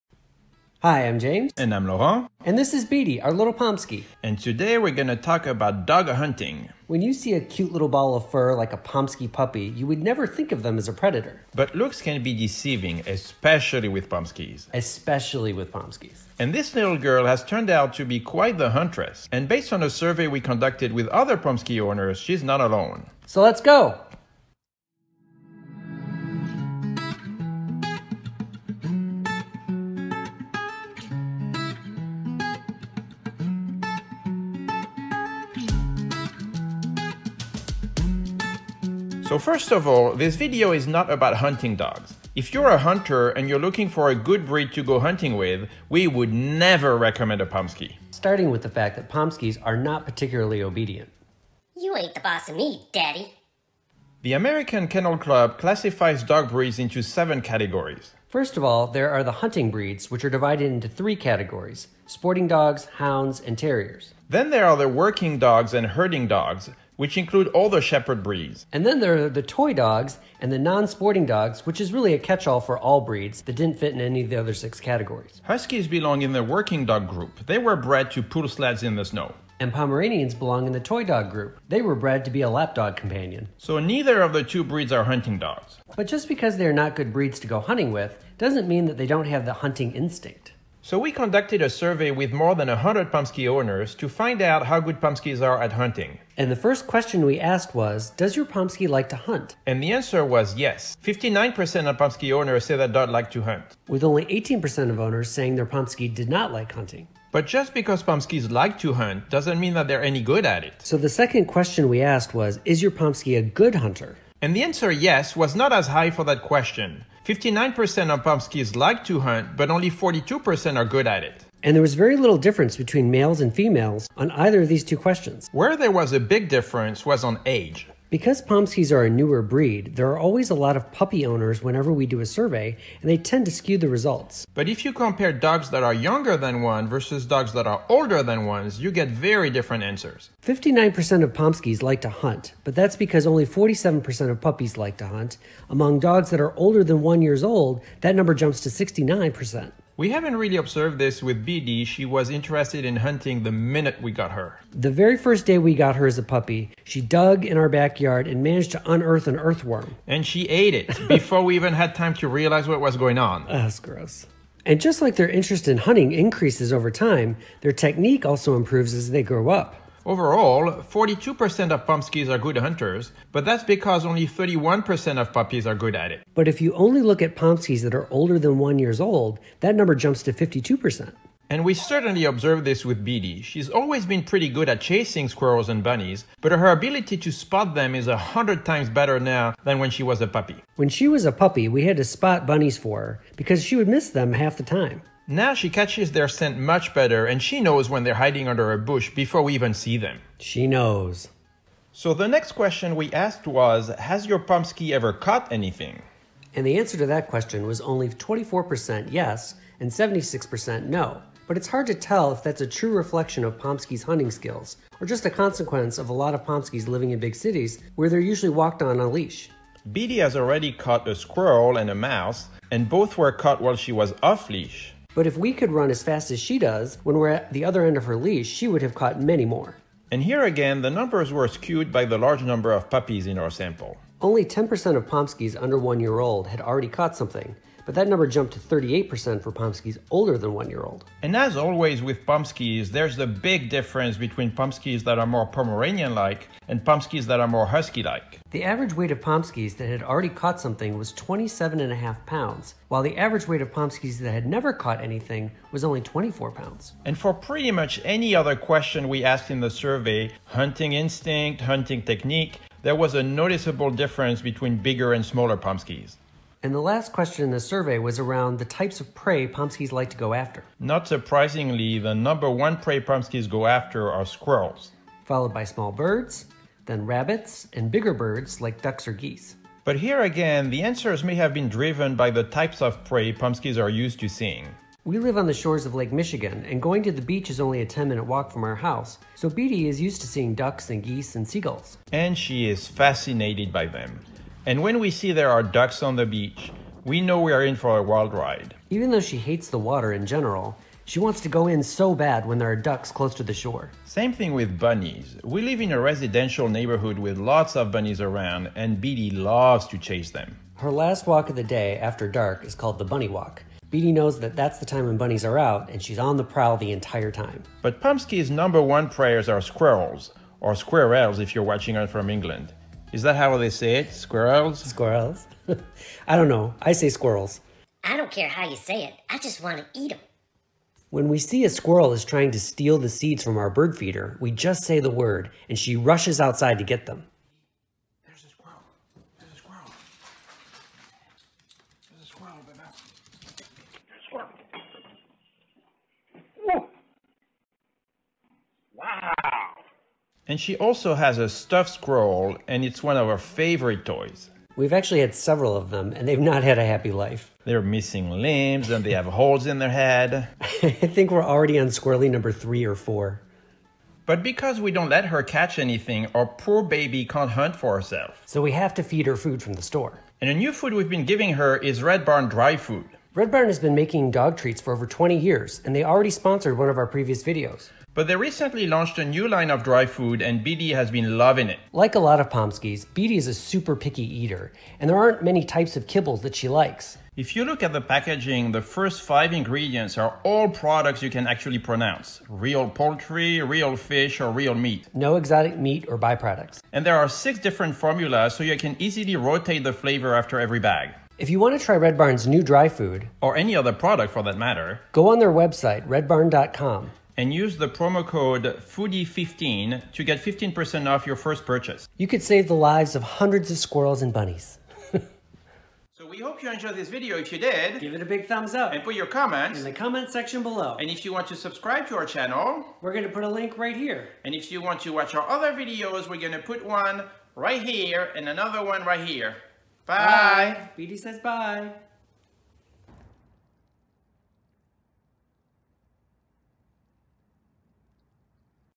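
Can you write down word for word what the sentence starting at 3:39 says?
Beedi has already caught a squirrel and a mouse, and both were caught while she was off leash.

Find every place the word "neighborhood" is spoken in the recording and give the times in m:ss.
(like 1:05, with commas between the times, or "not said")
5:06.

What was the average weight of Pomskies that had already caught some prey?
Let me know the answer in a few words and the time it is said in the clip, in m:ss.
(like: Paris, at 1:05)
27.5 pounds, at 4:11.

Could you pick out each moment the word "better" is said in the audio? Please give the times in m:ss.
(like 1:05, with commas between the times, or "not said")
3:08, 3:16.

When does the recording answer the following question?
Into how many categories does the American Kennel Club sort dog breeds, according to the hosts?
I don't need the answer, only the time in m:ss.
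0:57.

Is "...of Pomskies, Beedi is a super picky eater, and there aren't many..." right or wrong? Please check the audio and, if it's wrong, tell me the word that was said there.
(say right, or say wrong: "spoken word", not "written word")
right.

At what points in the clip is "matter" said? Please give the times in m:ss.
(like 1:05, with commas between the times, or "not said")
6:44.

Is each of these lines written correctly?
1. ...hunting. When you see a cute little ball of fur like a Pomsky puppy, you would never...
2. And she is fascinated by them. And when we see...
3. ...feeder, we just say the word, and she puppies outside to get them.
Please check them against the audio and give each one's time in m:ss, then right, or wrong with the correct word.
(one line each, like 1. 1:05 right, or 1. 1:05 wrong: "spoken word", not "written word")
1. 0:06 right
2. 4:52 right
3. 5:33 wrong: "rushes", not "puppies".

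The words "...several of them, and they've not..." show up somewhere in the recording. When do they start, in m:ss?
5:55.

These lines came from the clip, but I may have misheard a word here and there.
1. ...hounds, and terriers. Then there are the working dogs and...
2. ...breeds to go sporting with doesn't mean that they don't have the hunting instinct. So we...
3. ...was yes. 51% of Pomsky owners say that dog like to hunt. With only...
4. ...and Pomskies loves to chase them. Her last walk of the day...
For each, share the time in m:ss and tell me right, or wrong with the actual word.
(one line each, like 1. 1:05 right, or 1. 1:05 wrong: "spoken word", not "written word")
1. 1:02 right
2. 1:27 wrong: "hunting", not "sporting"
3. 1:40 wrong: "59", not "51"
4. 5:08 wrong: "Beedi", not "Pomskies".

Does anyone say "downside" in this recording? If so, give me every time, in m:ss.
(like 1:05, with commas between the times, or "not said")
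not said.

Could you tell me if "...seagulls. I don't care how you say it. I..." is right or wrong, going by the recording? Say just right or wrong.
wrong.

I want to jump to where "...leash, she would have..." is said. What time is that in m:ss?
3:48.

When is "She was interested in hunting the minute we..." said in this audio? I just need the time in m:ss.
2:31.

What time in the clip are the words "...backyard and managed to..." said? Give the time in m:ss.
2:37.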